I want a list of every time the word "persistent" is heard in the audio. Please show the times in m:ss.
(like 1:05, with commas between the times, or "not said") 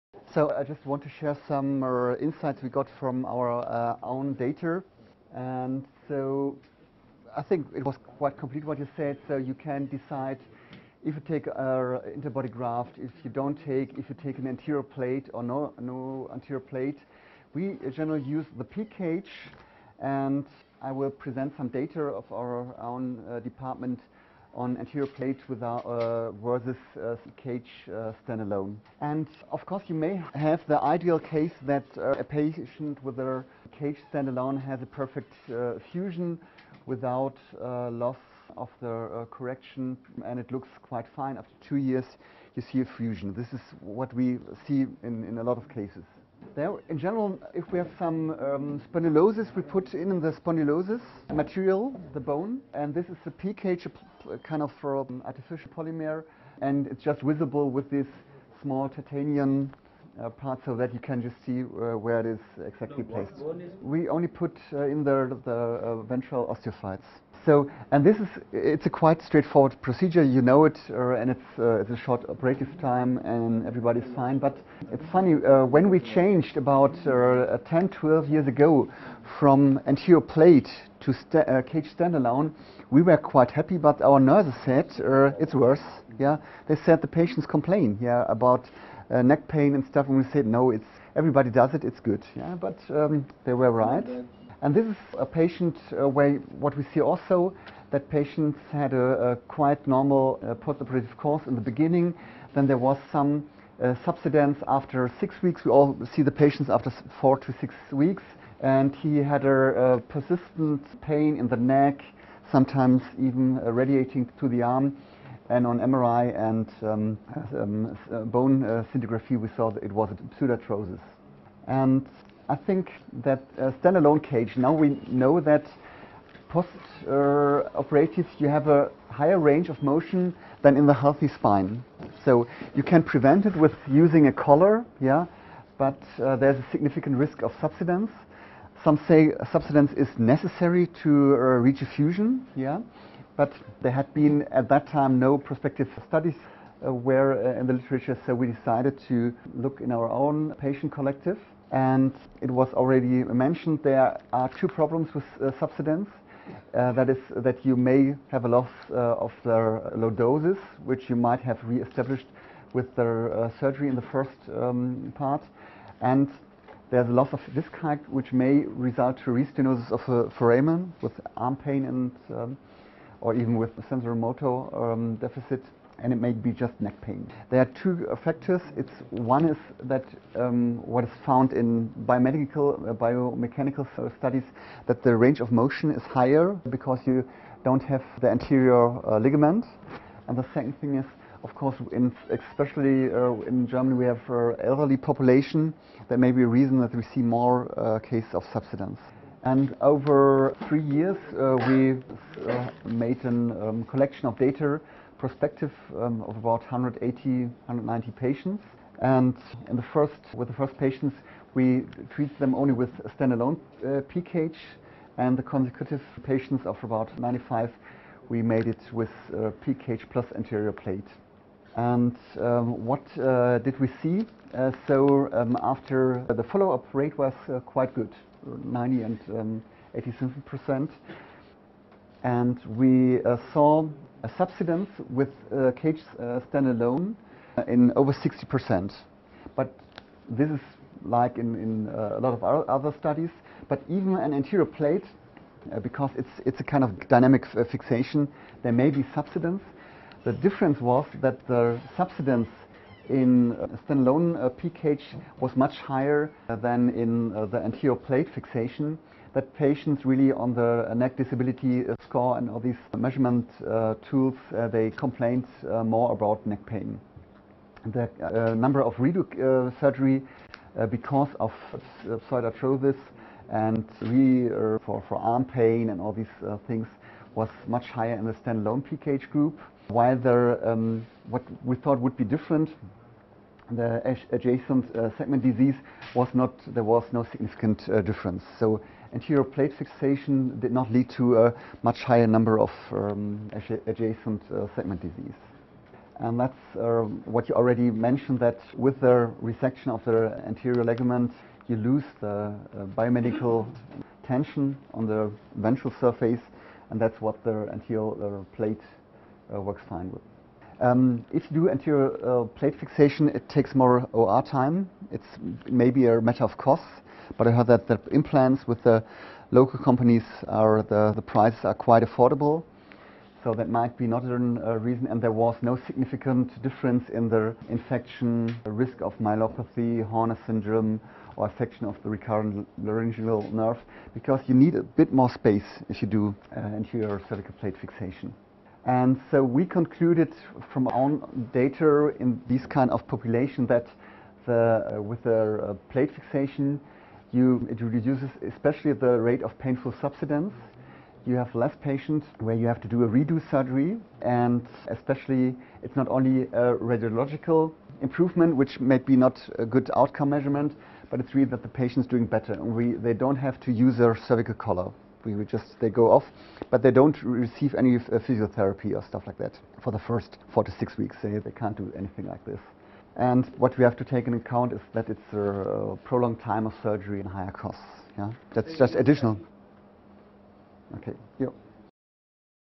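1:50.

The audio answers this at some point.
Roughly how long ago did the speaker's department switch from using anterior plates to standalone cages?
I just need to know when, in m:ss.
1:17.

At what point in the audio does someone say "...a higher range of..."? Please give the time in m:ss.
2:08.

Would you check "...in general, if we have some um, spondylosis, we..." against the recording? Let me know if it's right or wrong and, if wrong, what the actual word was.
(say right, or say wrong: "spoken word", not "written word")
right.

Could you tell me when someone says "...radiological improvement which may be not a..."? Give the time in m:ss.
5:56.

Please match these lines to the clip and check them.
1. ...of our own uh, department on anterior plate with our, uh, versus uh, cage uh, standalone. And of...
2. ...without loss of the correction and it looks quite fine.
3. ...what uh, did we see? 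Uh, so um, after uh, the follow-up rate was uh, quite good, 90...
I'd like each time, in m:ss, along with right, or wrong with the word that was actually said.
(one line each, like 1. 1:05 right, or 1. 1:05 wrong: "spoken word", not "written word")
1. 0:22 right
2. 0:36 right
3. 3:42 right.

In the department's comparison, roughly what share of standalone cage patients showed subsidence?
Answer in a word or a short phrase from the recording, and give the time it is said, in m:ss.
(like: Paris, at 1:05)
Over 60 percent, at 3:57.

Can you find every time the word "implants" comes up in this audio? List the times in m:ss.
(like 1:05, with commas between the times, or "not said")
5:18.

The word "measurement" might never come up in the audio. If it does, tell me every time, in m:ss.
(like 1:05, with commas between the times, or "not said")
4:22, 6:00.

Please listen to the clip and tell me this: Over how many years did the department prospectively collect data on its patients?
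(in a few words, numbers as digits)
3 years.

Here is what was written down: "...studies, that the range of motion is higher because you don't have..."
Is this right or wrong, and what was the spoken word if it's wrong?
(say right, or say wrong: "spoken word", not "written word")
right.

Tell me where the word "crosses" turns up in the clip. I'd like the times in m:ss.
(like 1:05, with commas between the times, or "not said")
not said.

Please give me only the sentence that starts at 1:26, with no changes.
They said the patients complain, yeah, about uh, neck pain and stuff, and we said, no, it's everybody does it, it's good.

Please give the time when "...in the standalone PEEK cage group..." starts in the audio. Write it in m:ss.
4:38.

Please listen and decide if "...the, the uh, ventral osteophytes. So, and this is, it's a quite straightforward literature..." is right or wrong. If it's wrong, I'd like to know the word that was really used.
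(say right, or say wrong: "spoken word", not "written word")
wrong: "procedure", not "literature".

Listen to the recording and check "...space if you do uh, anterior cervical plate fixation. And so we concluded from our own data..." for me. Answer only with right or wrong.
right.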